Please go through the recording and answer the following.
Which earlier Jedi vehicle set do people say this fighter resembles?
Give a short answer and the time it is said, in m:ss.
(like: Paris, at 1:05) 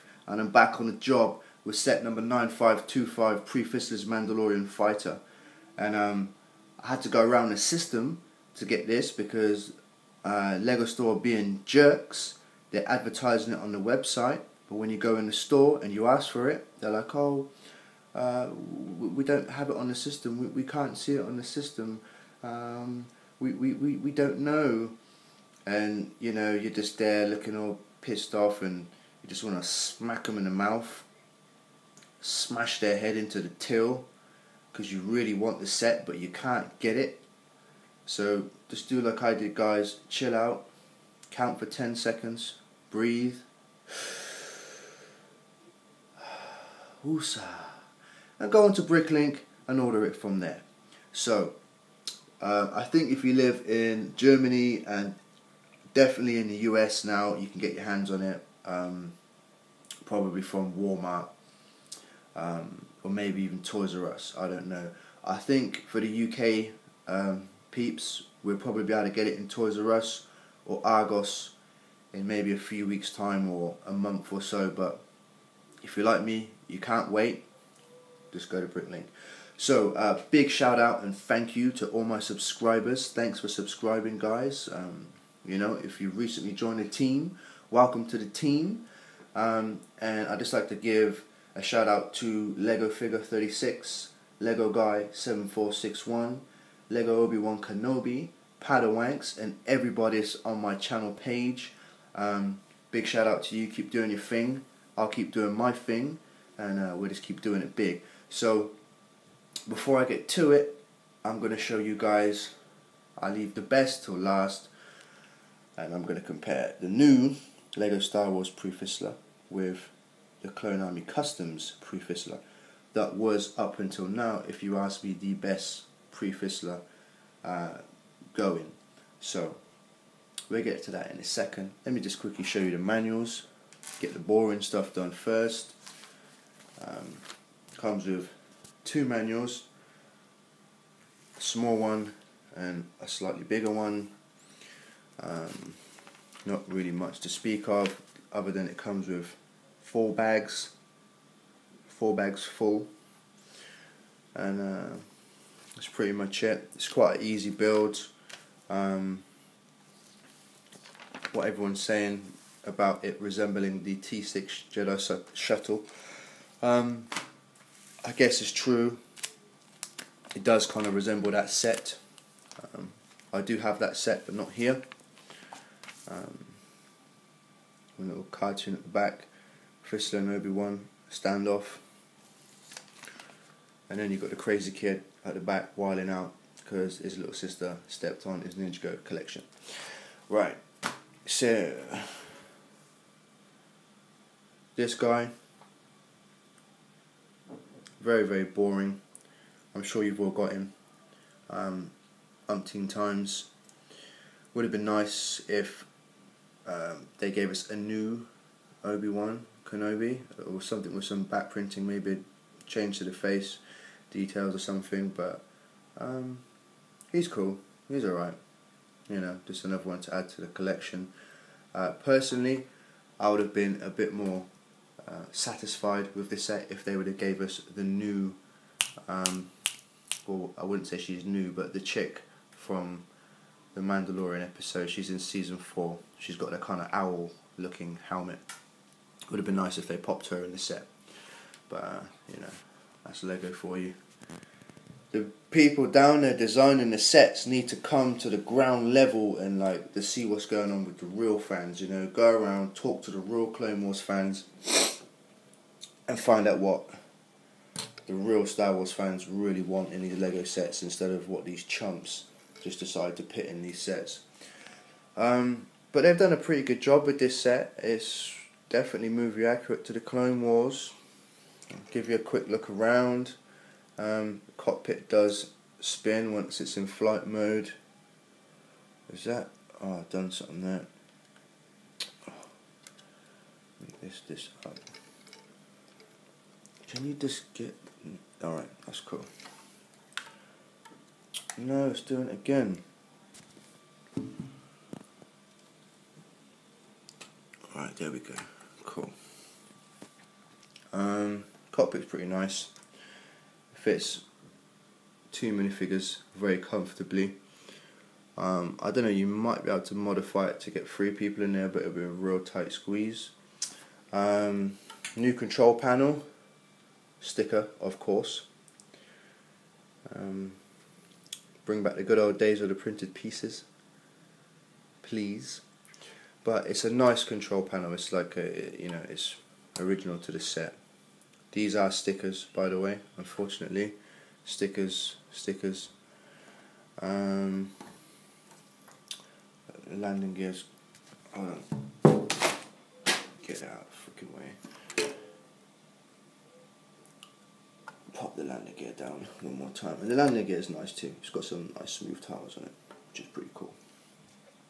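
T6 Jedi shuttle, at 2:43.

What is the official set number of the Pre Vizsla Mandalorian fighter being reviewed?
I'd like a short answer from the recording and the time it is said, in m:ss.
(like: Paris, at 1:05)
9525, at 0:02.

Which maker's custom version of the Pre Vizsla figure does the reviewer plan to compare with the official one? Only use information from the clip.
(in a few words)
Clone Army Customs.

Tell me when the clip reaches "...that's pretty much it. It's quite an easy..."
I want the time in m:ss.
2:35.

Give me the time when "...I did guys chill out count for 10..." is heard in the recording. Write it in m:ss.
0:39.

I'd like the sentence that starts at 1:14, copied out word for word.
But if you're like me, you can't wait.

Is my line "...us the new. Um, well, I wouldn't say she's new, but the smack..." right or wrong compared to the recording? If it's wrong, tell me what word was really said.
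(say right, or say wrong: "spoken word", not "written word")
wrong: "chick", not "smack".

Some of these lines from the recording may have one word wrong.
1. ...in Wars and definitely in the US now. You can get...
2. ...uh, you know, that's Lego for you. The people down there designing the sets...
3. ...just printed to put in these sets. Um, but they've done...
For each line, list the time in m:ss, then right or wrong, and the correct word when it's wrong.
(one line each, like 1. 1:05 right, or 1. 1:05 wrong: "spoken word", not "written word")
1. 0:53 wrong: "Germany", not "Wars"
2. 4:01 right
3. 4:22 wrong: "decided", not "printed".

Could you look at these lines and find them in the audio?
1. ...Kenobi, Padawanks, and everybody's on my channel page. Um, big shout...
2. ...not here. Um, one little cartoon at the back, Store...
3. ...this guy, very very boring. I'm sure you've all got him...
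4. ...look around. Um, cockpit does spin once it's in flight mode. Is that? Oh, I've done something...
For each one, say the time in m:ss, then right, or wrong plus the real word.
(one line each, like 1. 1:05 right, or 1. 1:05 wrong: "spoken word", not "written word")
1. 1:37 right
2. 2:54 wrong: "Vizsla", not "Store"
3. 3:14 right
4. 4:32 right.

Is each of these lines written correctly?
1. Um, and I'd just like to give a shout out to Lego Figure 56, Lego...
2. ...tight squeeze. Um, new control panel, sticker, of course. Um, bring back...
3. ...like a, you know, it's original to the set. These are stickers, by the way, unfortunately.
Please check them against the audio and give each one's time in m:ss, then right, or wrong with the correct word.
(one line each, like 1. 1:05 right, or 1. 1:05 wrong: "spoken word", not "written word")
1. 1:29 wrong: "36", not "56"
2. 5:12 right
3. 5:28 right.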